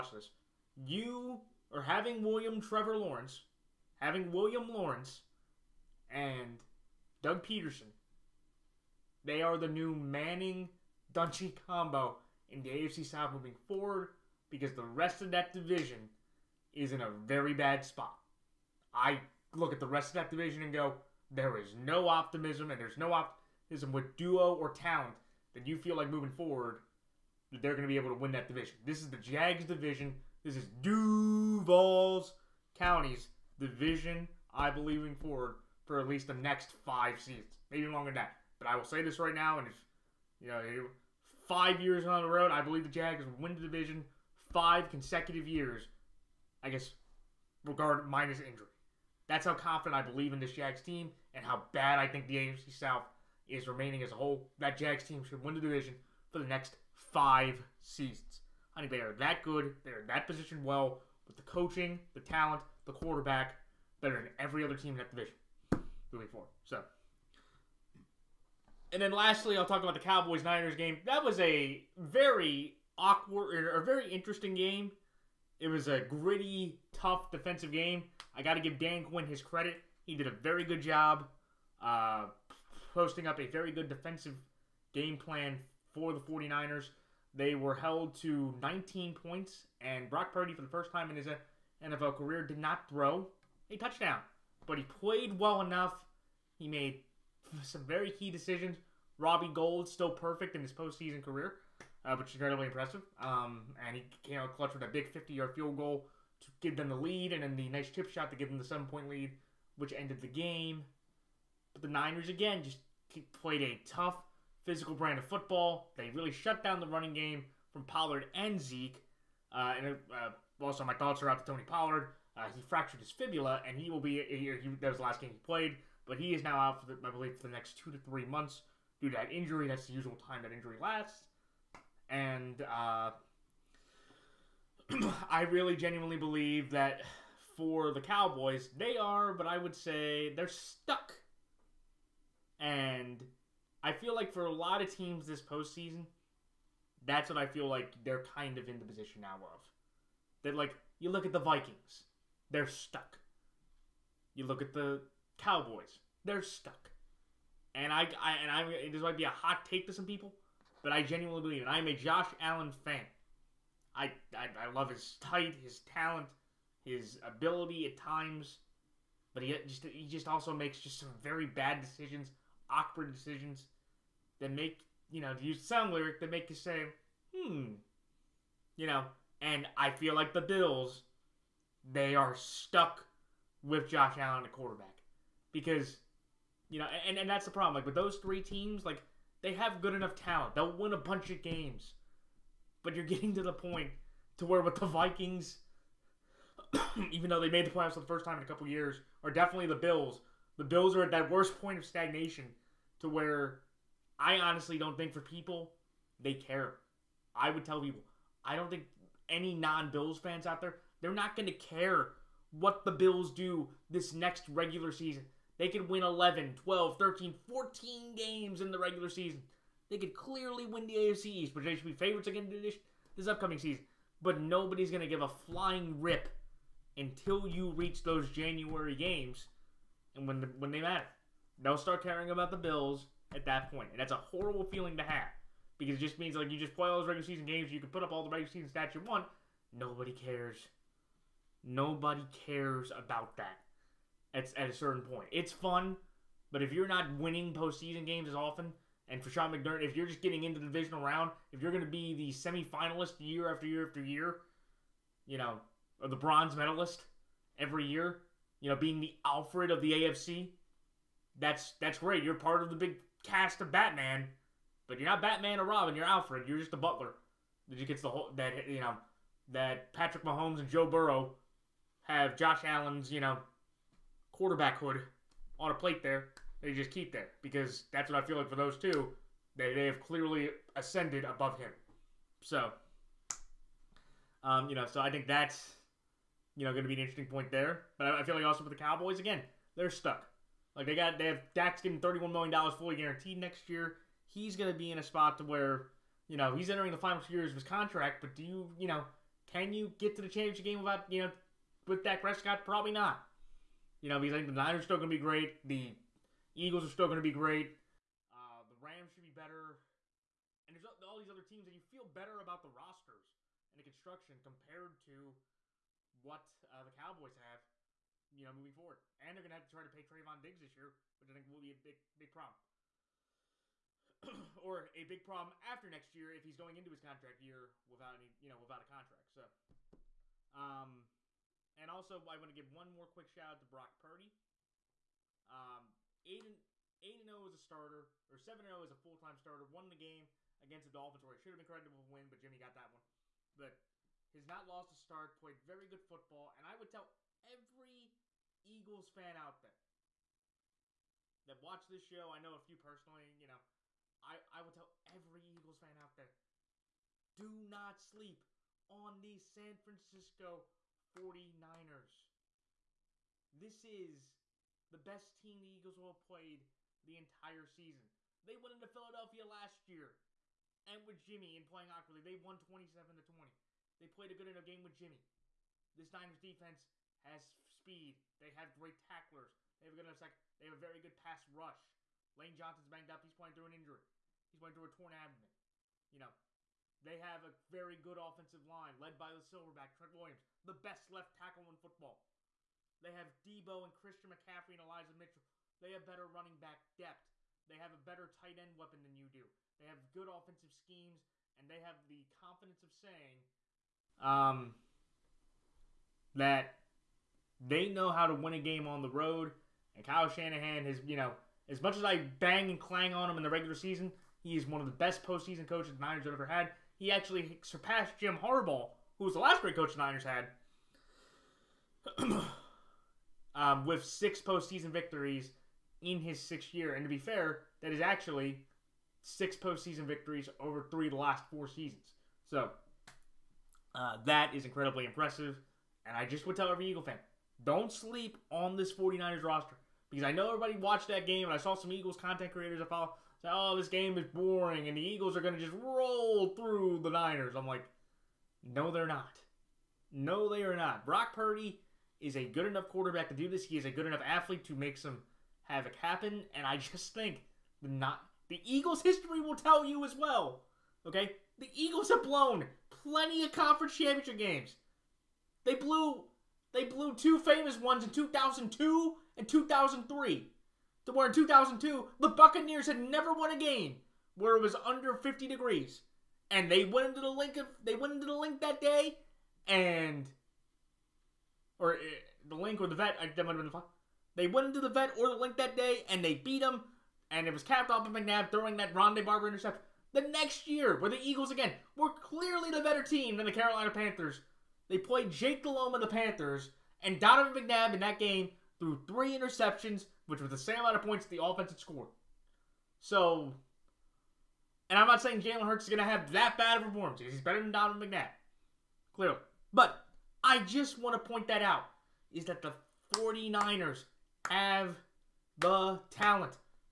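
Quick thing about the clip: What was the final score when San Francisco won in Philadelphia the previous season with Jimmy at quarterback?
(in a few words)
27-20.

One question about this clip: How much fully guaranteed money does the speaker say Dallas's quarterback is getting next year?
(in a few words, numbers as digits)
$31 million.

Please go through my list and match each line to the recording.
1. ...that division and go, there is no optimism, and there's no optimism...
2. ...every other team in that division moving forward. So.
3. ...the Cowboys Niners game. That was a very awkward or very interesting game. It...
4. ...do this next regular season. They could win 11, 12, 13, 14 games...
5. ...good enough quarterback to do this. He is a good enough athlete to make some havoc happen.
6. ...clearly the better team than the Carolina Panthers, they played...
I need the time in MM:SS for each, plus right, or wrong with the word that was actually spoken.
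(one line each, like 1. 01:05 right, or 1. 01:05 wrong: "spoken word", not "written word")
1. 00:20 right
2. 01:04 right
3. 01:09 right
4. 03:33 right
5. 07:32 right
6. 08:12 right.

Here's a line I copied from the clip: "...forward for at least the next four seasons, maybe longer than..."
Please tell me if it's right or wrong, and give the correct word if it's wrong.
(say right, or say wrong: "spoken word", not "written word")
wrong: "five", not "four".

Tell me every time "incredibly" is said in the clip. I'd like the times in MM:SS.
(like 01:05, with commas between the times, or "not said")
01:42, 07:14.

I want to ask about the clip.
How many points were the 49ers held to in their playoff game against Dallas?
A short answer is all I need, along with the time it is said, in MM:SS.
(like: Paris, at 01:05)
19, at 01:28.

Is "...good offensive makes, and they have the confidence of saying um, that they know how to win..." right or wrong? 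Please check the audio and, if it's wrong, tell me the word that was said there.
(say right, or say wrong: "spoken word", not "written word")
wrong: "schemes", not "makes".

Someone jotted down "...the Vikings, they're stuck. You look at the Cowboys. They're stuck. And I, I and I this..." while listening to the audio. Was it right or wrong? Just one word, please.
right.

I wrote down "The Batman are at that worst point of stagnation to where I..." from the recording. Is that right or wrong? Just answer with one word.
wrong.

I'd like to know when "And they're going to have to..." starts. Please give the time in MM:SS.
05:19.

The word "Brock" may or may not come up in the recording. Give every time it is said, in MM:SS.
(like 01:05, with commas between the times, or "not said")
01:30, 05:33, 07:31.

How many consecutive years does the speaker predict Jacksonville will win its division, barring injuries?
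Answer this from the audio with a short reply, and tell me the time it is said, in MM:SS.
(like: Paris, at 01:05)
5, at 00:44.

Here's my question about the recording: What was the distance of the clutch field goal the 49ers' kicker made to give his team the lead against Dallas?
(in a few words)
50 yards.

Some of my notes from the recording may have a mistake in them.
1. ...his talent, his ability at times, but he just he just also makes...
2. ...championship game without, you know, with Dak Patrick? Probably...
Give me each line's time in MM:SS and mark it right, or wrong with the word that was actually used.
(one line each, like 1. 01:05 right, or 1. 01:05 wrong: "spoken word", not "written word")
1. 02:45 right
2. 05:00 wrong: "Prescott", not "Patrick".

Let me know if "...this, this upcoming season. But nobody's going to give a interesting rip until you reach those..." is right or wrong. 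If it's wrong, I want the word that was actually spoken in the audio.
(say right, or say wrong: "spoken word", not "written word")
wrong: "flying", not "interesting".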